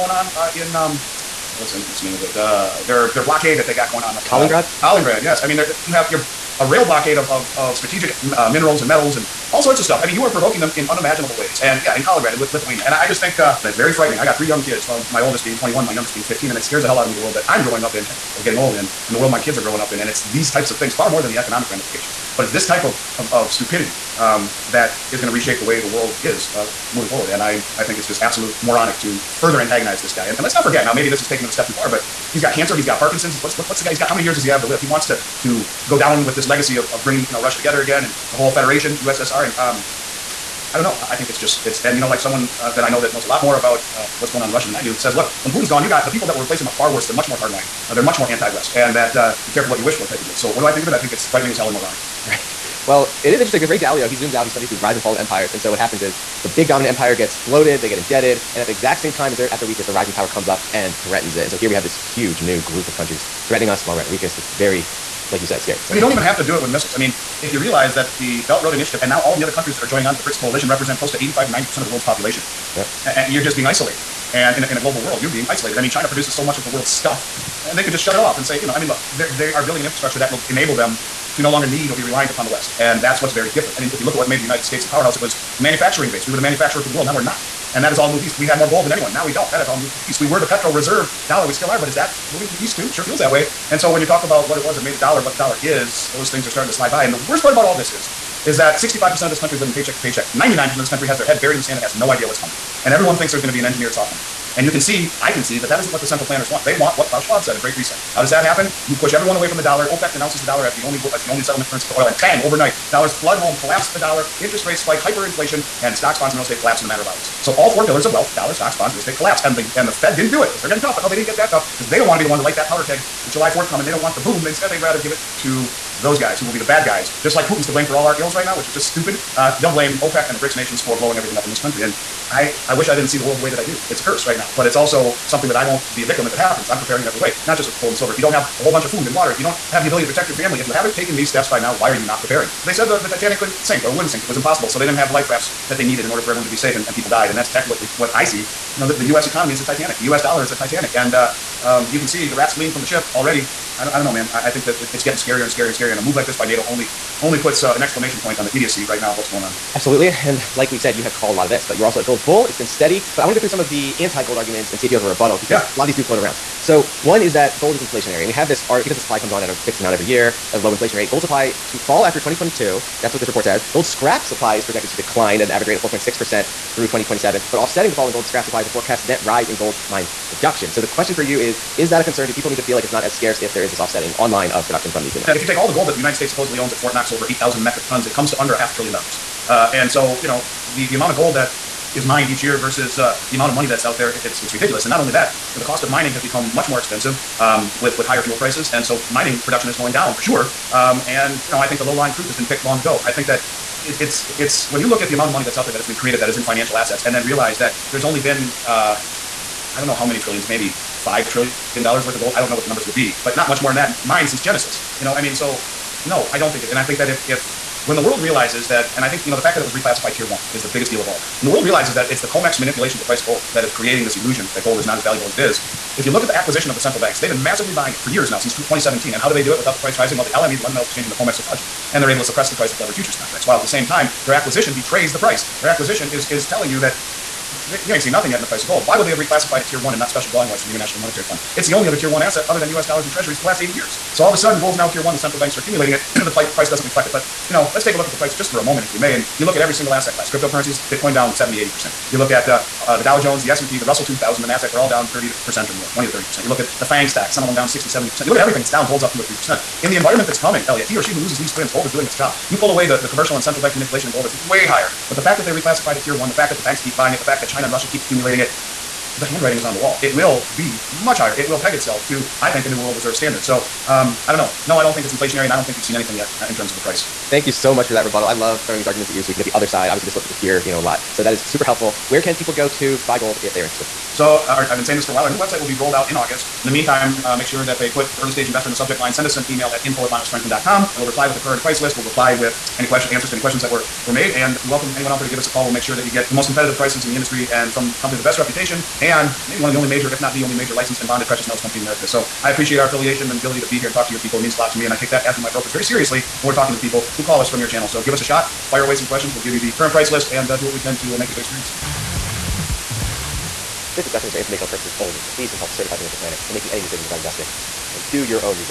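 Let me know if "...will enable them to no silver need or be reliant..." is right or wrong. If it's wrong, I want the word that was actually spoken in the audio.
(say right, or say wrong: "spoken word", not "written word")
wrong: "longer", not "silver".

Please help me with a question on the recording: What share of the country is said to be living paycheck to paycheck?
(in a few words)
65%.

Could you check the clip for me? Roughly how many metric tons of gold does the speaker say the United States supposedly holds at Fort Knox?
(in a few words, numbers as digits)
over 8,000.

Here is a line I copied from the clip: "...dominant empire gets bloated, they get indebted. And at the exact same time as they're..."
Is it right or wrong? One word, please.
right.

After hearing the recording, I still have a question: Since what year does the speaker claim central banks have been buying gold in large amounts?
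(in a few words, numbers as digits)
2017.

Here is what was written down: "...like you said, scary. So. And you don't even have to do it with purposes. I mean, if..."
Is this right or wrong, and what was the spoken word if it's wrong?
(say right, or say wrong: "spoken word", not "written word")
wrong: "missiles", not "purposes".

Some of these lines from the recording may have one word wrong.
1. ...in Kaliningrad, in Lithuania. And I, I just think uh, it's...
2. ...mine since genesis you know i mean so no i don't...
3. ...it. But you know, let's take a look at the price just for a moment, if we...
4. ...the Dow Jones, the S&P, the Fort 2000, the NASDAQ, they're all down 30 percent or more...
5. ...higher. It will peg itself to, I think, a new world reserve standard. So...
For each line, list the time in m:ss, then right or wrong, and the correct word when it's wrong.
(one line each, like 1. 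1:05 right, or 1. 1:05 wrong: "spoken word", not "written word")
1. 0:11 right
2. 3:34 right
3. 4:07 right
4. 4:12 wrong: "Russell", not "Fort"
5. 4:31 right.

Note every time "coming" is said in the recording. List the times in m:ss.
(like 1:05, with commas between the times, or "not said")
1:42, 2:03, 4:20.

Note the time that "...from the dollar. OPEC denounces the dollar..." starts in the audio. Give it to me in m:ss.
1:49.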